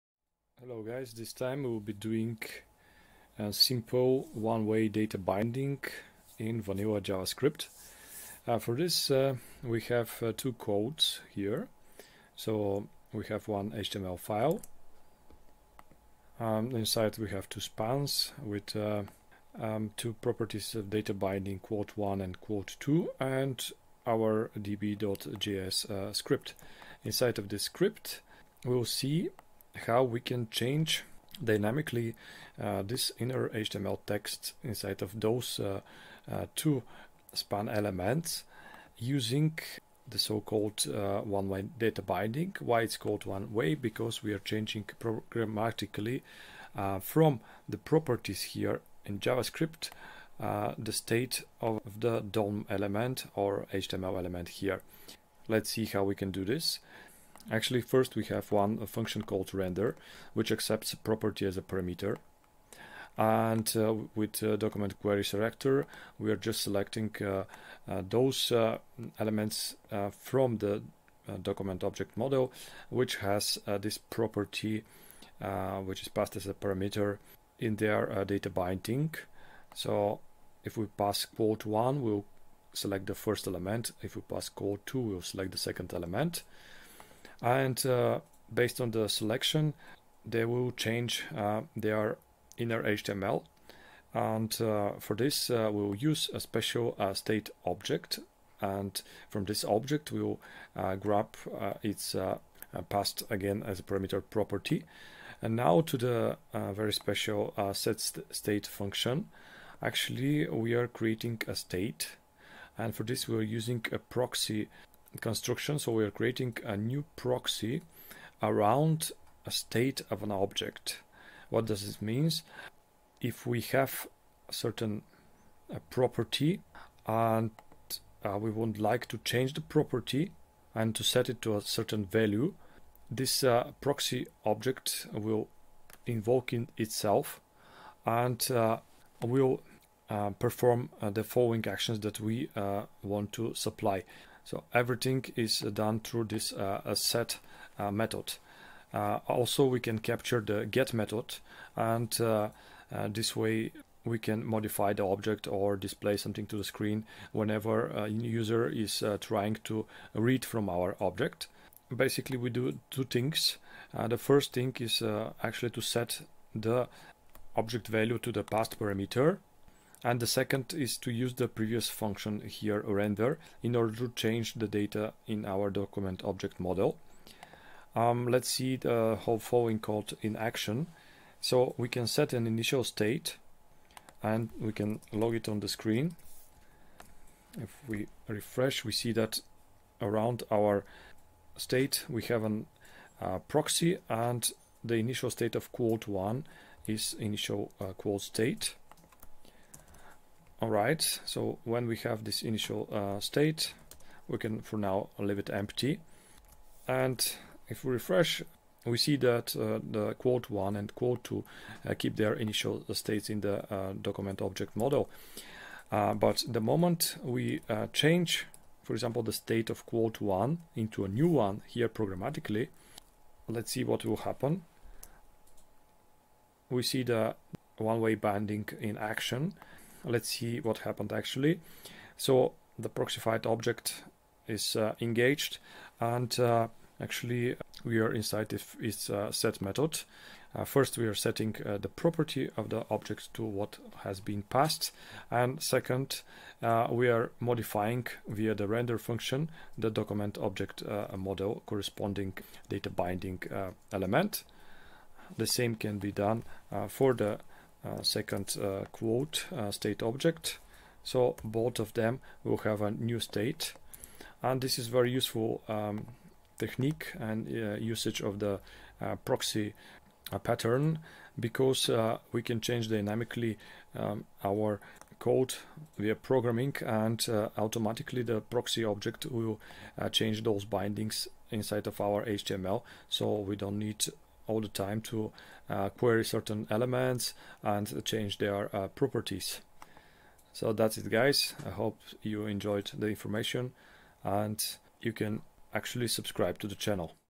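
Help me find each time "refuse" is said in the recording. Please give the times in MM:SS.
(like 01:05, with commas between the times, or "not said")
not said.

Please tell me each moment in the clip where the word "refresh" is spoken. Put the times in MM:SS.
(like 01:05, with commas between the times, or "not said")
03:08, 03:27.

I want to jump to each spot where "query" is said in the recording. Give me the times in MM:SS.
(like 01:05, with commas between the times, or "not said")
01:05, 04:45.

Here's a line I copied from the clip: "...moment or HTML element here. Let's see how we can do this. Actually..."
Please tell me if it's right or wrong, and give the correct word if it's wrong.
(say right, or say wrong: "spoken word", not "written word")
wrong: "element", not "moment".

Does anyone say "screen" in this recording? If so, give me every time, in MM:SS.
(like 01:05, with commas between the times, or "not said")
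02:36, 03:05.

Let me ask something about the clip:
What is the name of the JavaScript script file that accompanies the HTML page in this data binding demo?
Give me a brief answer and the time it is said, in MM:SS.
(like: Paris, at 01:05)
db.js, at 00:24.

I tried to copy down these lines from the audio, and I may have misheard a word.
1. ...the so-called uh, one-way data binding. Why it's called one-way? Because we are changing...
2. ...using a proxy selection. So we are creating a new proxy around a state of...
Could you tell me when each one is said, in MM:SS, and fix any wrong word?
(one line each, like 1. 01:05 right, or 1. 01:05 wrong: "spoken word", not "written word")
1. 00:40 right
2. 01:53 wrong: "construction", not "selection".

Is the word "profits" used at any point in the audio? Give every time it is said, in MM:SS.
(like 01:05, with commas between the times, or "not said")
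not said.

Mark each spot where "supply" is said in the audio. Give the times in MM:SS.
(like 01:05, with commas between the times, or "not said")
02:23.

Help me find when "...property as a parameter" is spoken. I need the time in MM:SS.
01:00.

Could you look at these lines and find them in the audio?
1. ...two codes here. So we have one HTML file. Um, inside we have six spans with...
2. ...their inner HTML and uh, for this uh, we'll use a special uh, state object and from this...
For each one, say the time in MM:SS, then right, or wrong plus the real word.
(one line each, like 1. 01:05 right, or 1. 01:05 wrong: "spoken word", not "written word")
1. 00:10 wrong: "two", not "six"
2. 01:31 right.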